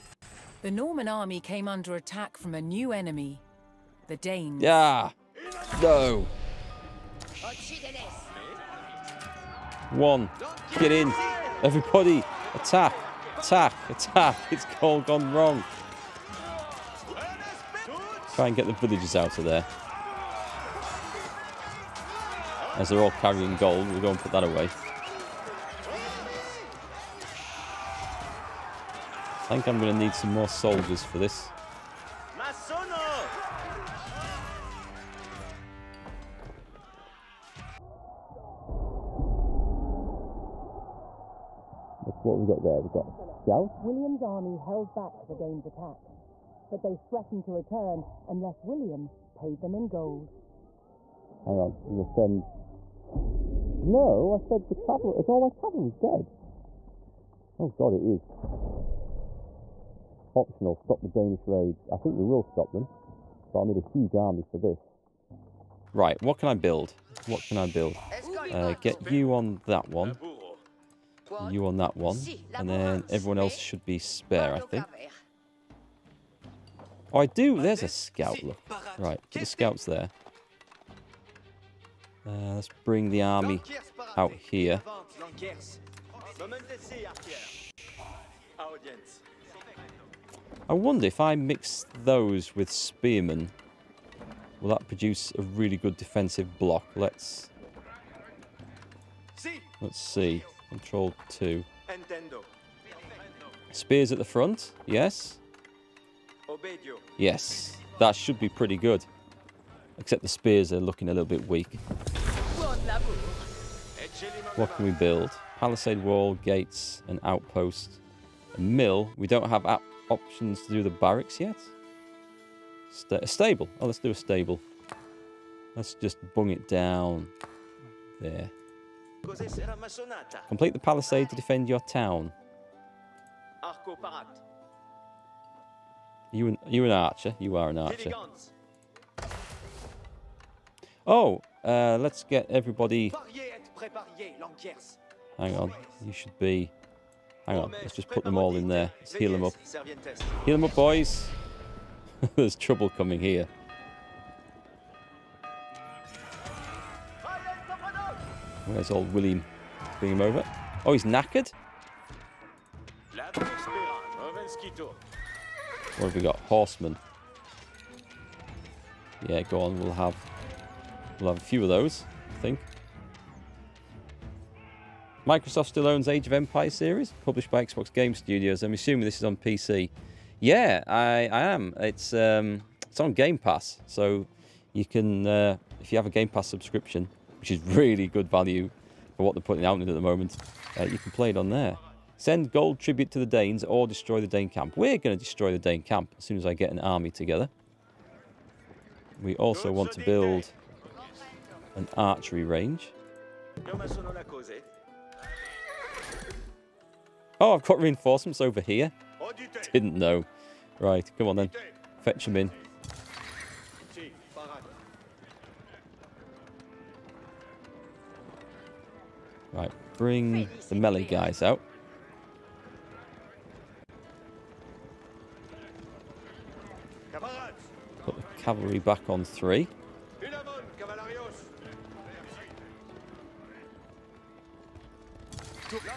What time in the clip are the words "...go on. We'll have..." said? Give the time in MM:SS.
02:49.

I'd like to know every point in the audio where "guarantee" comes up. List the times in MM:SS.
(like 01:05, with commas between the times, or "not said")
not said.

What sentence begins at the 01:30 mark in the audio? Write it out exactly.
I wonder if I mix those with spearmen, will that produce a really good defensive block?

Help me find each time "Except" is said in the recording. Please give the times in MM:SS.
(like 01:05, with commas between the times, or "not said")
01:49.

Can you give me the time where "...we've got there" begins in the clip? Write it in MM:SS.
00:42.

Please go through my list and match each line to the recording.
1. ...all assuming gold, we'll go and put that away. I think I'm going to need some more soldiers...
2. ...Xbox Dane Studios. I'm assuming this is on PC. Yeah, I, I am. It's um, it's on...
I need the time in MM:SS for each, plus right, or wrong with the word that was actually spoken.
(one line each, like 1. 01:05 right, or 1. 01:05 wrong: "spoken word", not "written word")
1. 00:22 wrong: "carrying", not "assuming"
2. 02:57 wrong: "Game", not "Dane".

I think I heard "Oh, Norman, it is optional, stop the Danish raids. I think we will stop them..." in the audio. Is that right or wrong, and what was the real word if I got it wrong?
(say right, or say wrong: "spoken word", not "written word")
wrong: "God", not "Norman".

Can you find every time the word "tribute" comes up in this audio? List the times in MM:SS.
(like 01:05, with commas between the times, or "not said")
03:12.